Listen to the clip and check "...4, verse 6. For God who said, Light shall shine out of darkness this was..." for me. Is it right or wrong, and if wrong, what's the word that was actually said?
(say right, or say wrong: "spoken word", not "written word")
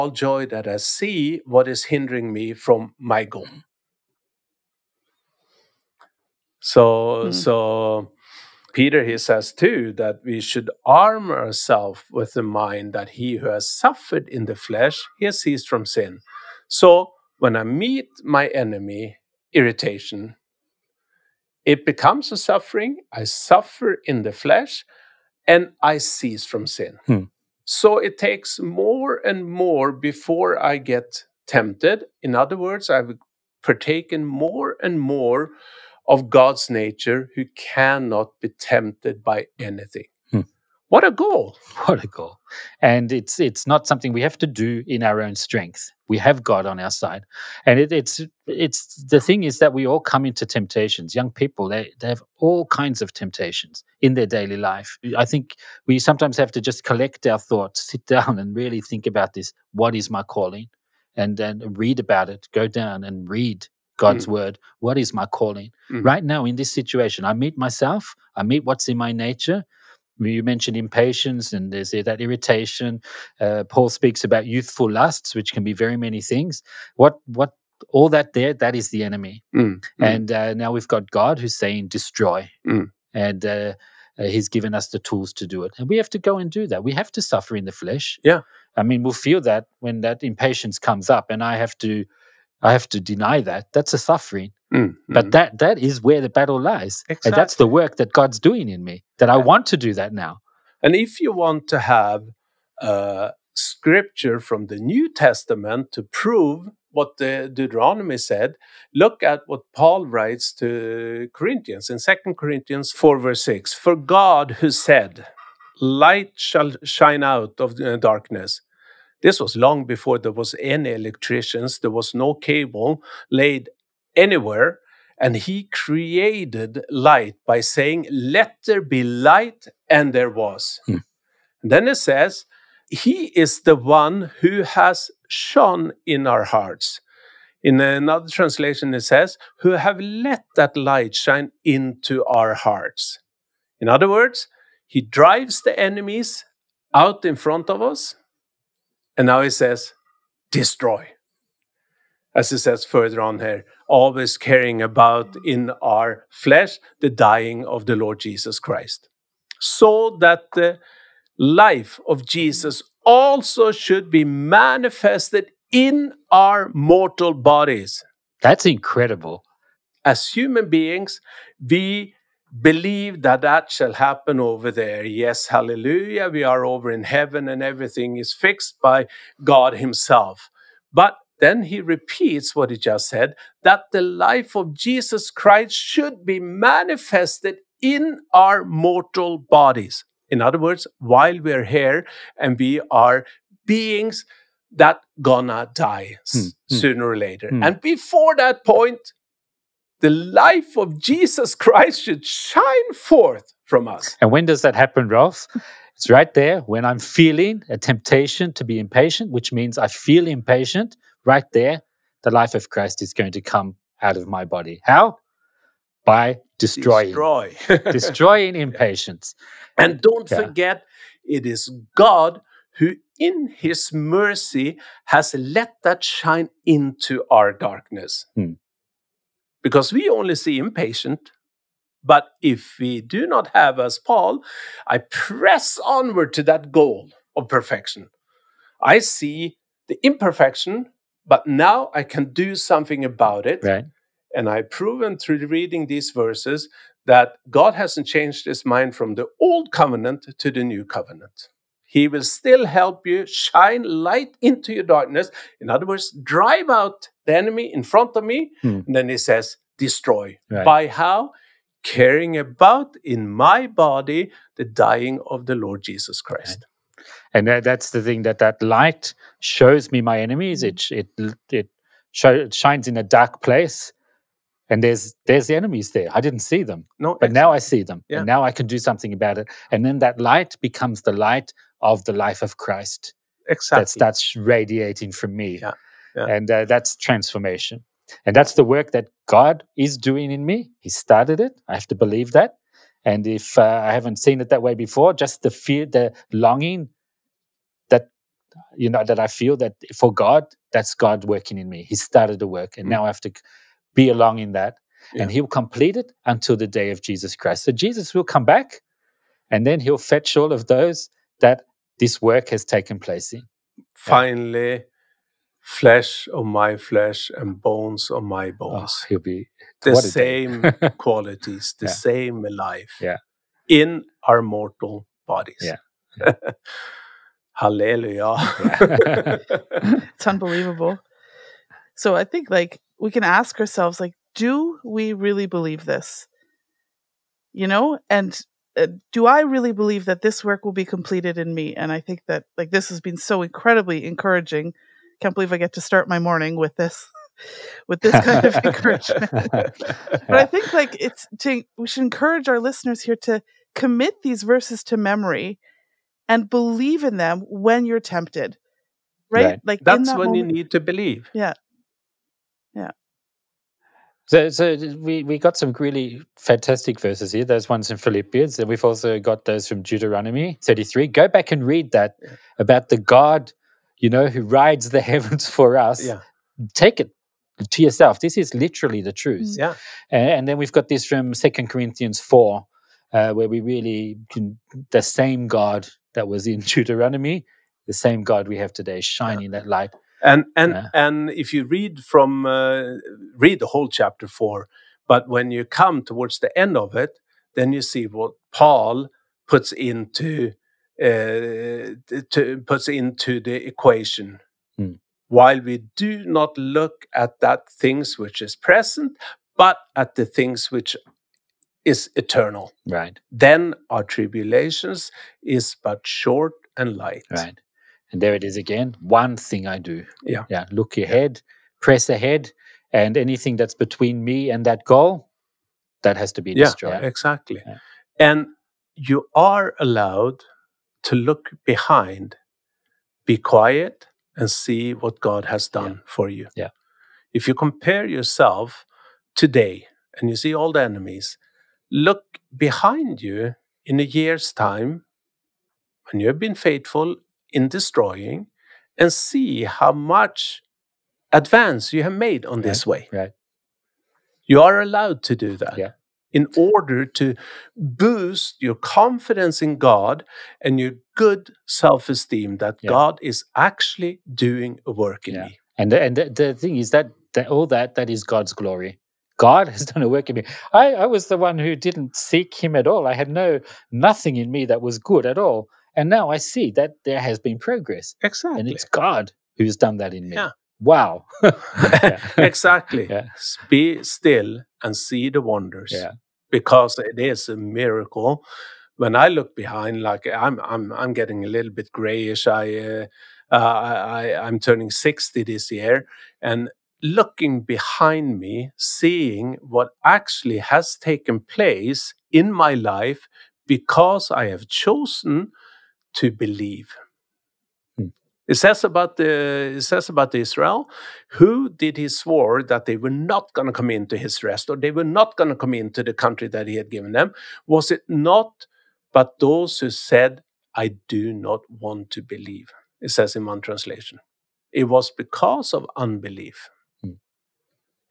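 right.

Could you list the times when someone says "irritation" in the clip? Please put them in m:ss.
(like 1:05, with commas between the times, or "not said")
0:19, 1:12.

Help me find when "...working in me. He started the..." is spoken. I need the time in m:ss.
5:01.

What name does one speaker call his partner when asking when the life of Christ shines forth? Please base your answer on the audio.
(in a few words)
Rolf.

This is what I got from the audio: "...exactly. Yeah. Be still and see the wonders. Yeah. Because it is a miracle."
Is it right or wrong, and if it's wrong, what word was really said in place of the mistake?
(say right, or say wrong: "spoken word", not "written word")
right.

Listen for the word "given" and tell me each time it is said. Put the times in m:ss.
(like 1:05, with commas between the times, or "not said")
1:24, 8:36.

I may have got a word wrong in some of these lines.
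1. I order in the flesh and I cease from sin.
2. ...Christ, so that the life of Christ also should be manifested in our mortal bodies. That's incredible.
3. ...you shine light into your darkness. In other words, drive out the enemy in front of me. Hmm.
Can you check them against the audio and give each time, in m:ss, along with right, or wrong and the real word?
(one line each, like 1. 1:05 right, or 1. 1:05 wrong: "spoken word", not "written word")
1. 0:23 wrong: "suffer", not "order"
2. 2:38 wrong: "Jesus", not "Christ"
3. 4:13 right.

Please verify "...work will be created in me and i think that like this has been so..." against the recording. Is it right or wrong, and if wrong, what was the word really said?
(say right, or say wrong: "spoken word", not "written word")
wrong: "completed", not "created".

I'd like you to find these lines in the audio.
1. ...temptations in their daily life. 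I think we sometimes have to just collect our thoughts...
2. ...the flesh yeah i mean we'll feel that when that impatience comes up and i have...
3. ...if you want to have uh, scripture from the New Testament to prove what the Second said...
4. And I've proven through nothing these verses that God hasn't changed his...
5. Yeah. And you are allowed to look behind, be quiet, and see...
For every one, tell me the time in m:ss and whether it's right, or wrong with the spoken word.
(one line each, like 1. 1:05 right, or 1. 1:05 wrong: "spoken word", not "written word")
1. 0:53 right
2. 1:27 right
3. 1:40 wrong: "Deuteronomy", not "Second"
4. 4:04 wrong: "reading", not "nothing"
5. 7:07 right.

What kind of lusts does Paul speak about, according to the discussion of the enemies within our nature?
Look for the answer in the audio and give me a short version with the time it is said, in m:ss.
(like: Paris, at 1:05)
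Youthful lusts, at 1:14.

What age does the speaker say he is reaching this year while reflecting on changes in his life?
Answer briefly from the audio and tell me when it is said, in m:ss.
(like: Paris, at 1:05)
60, at 8:14.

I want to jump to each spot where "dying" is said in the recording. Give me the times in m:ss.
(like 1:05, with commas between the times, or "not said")
2:37, 4:24.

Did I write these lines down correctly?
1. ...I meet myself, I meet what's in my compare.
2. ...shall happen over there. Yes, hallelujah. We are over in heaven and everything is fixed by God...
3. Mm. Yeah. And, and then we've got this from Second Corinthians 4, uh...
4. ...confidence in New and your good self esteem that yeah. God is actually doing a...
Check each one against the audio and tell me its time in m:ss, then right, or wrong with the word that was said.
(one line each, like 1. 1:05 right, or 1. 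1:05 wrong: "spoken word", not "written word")
1. 1:07 wrong: "nature", not "compare"
2. 2:53 right
3. 6:19 right
4. 7:38 wrong: "God", not "New".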